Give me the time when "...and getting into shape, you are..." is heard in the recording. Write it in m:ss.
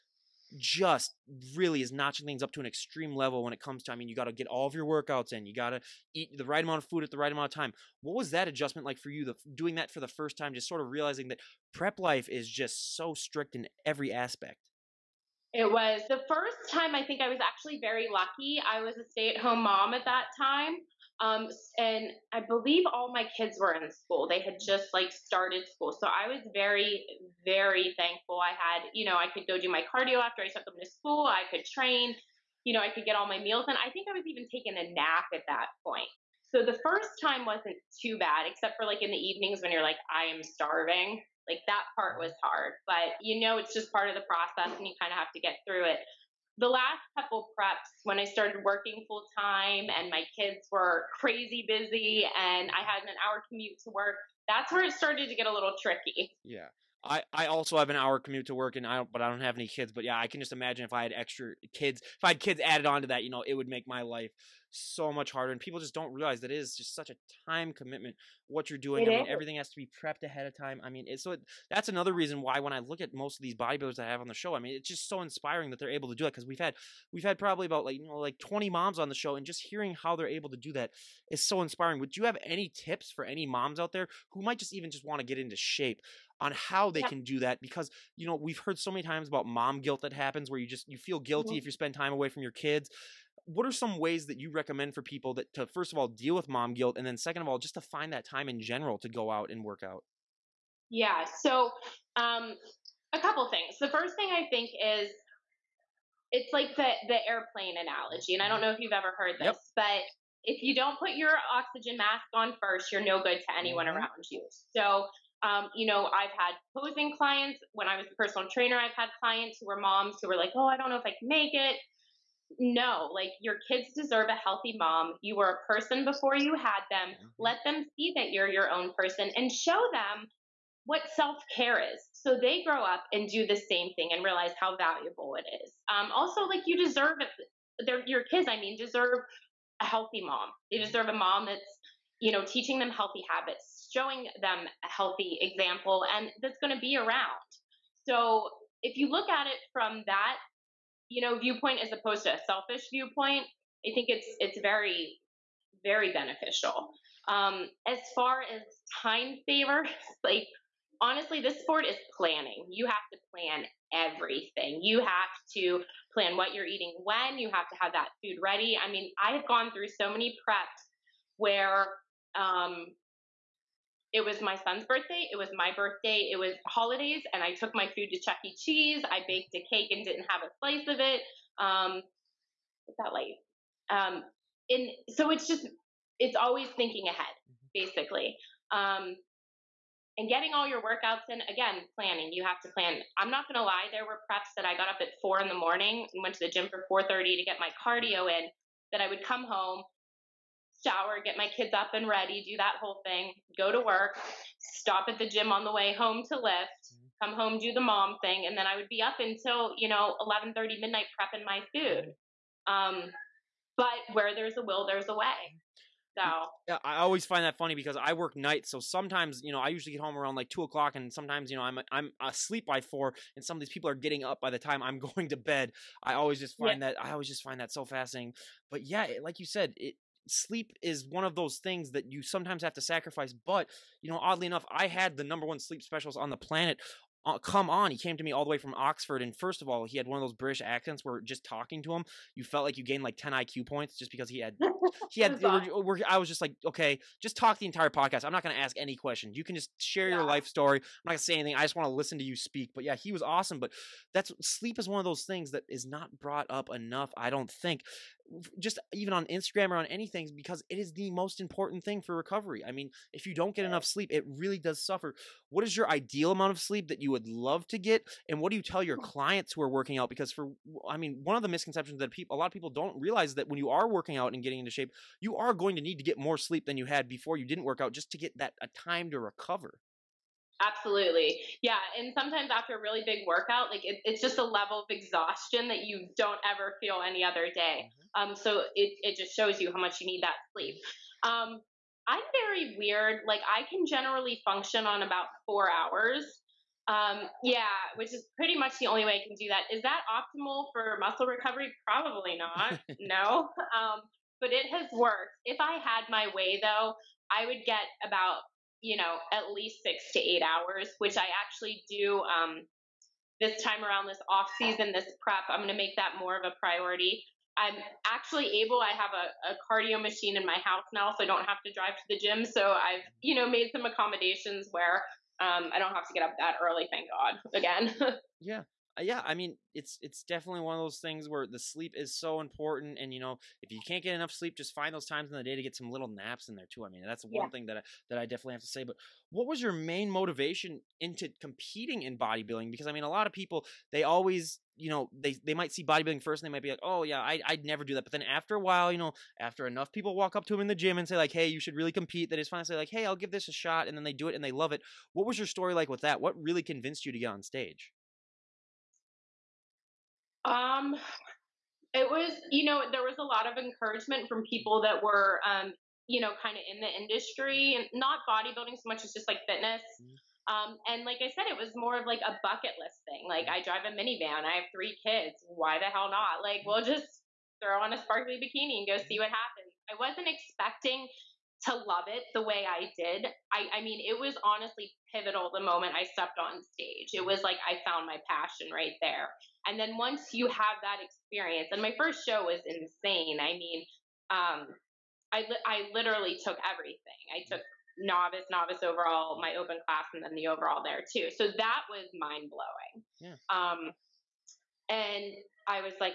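4:34.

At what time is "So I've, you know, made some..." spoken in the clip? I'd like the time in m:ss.
5:22.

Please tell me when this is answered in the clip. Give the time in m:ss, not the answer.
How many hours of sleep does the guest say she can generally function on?
4:55.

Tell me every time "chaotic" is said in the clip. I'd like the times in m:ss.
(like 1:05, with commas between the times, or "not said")
not said.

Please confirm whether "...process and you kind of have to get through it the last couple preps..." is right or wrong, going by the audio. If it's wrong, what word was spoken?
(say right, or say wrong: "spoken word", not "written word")
right.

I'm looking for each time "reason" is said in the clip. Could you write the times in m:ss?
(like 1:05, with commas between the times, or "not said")
1:12.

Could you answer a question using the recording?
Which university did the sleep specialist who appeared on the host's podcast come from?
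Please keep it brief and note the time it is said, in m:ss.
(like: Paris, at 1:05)
Oxford, at 3:58.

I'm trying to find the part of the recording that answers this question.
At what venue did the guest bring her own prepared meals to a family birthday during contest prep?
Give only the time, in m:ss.
2:58.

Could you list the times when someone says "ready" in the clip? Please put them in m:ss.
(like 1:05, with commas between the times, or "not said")
2:48, 3:22.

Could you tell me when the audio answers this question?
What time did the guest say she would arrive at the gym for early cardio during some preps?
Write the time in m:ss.
3:16.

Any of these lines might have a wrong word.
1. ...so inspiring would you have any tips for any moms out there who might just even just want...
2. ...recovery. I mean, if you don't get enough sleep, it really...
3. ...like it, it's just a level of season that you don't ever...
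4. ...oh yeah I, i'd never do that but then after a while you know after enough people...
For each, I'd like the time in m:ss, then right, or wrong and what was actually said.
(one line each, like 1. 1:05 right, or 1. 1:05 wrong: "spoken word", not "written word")
1. 1:21 right
2. 4:22 right
3. 4:43 wrong: "exhaustion", not "season"
4. 5:46 right.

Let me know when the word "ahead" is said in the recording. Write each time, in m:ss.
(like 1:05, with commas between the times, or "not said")
1:10, 3:07.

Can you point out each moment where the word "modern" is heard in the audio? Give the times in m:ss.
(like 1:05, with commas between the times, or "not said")
not said.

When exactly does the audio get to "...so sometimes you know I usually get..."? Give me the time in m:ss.
3:38.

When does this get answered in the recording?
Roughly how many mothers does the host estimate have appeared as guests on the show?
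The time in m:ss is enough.
1:18.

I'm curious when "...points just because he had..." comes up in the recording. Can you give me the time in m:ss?
4:03.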